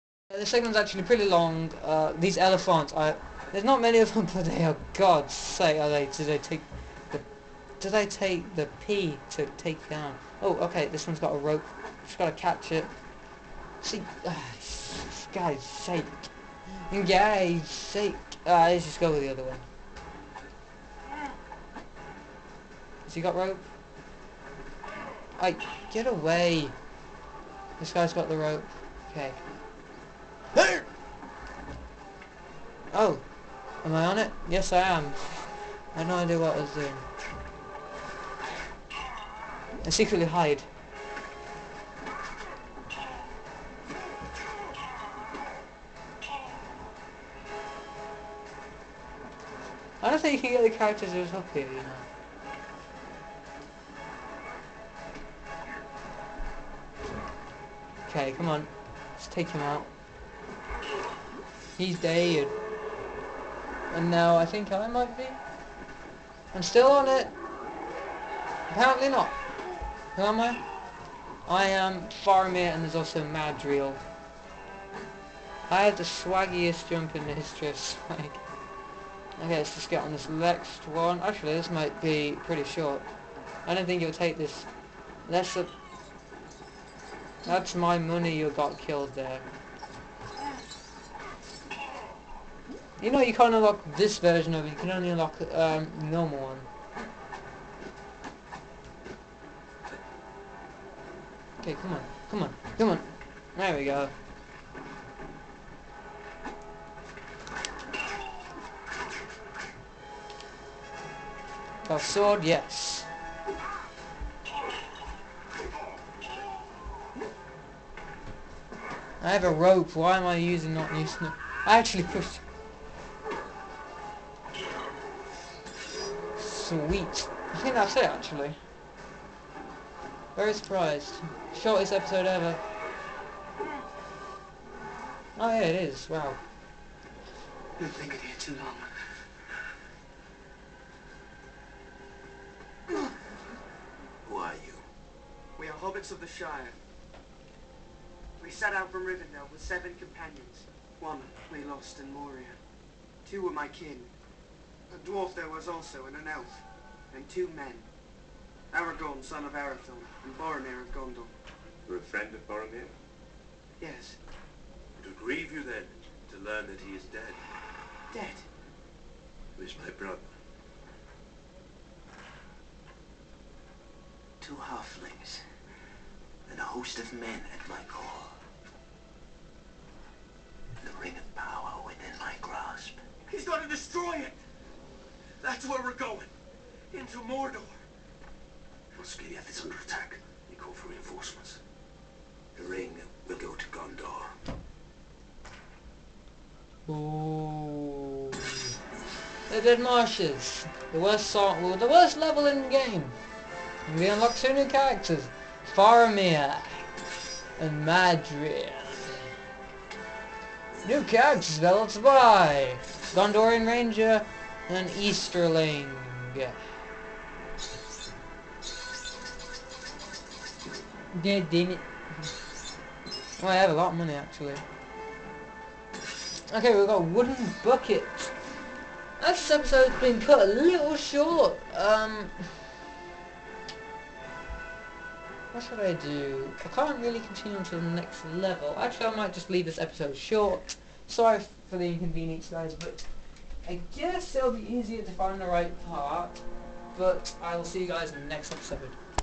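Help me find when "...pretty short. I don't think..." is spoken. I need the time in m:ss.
1:22.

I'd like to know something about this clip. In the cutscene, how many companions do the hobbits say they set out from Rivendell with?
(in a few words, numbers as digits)
7.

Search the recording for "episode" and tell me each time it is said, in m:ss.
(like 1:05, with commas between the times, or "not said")
2:11, 3:49, 3:59, 4:08.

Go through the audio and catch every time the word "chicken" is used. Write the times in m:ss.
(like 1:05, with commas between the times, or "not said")
not said.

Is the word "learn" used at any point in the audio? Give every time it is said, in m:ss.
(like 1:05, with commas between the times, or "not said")
2:46.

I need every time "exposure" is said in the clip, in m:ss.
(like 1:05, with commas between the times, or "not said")
not said.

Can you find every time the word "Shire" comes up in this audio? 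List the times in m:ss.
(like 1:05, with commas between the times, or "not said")
2:26.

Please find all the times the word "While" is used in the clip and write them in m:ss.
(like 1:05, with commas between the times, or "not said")
3:08.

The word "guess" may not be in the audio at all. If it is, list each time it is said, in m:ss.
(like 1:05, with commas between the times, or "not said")
4:03.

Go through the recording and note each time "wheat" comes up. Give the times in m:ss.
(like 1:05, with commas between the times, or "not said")
2:06.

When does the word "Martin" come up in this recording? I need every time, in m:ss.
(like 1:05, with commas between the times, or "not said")
not said.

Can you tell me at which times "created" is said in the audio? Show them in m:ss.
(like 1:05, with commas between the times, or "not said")
not said.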